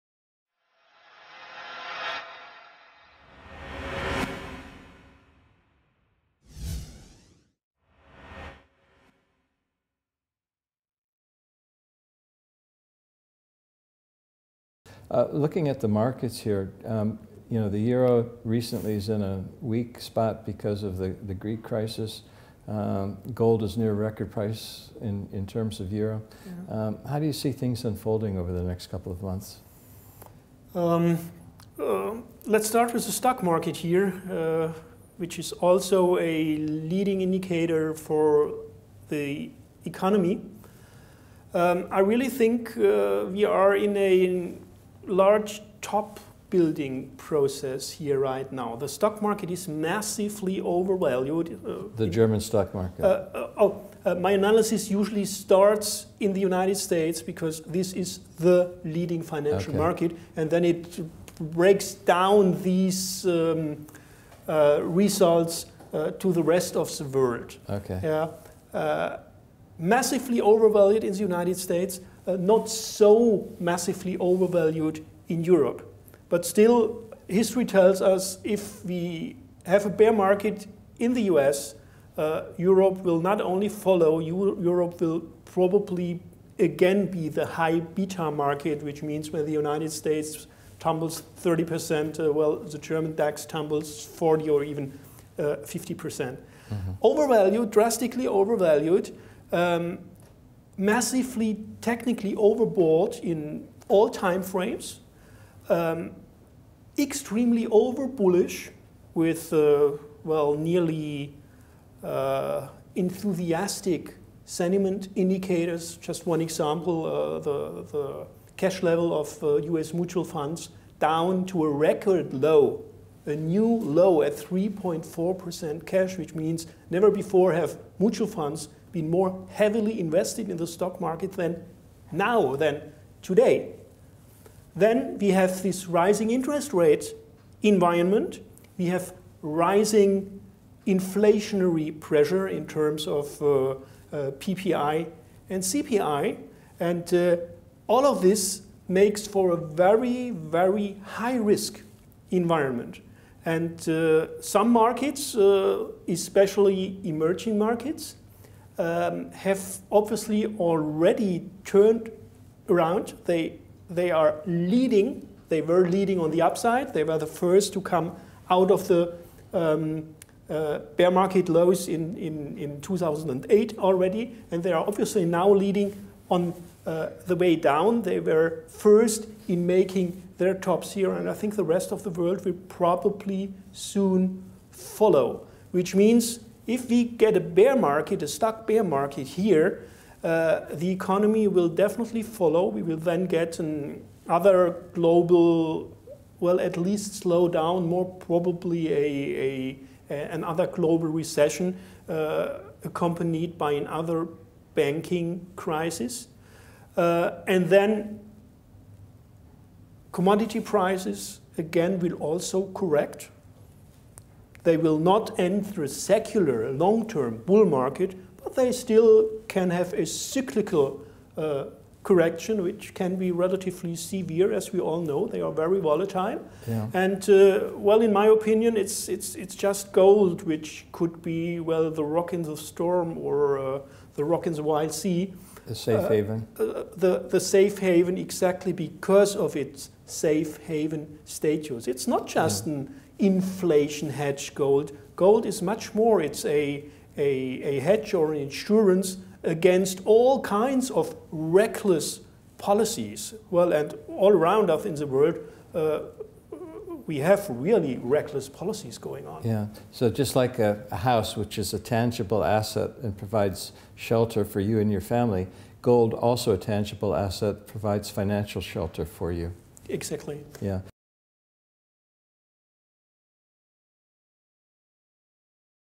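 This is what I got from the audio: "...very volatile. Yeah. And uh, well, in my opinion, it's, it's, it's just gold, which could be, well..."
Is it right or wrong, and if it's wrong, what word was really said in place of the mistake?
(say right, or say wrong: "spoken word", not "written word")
right.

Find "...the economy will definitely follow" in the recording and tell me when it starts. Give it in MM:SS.
03:10.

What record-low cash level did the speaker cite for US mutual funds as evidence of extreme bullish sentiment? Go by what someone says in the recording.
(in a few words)
3.4%.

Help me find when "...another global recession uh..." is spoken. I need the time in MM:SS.
03:20.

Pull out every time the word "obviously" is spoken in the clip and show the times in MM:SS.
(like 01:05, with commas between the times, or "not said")
02:39, 02:54.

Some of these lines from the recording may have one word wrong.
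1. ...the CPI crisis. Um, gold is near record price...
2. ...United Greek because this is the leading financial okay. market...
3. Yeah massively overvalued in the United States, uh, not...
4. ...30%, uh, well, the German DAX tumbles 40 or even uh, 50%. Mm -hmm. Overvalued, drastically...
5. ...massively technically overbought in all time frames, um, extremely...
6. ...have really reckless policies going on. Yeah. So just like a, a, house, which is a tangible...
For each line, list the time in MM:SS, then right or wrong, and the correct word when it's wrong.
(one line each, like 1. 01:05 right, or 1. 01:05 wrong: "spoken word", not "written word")
1. 00:21 wrong: "Greek", not "CPI"
2. 00:56 wrong: "States", not "Greek"
3. 01:08 right
4. 01:31 right
5. 01:40 right
6. 04:17 right.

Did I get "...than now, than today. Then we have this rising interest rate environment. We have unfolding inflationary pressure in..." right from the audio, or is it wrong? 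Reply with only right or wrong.
wrong.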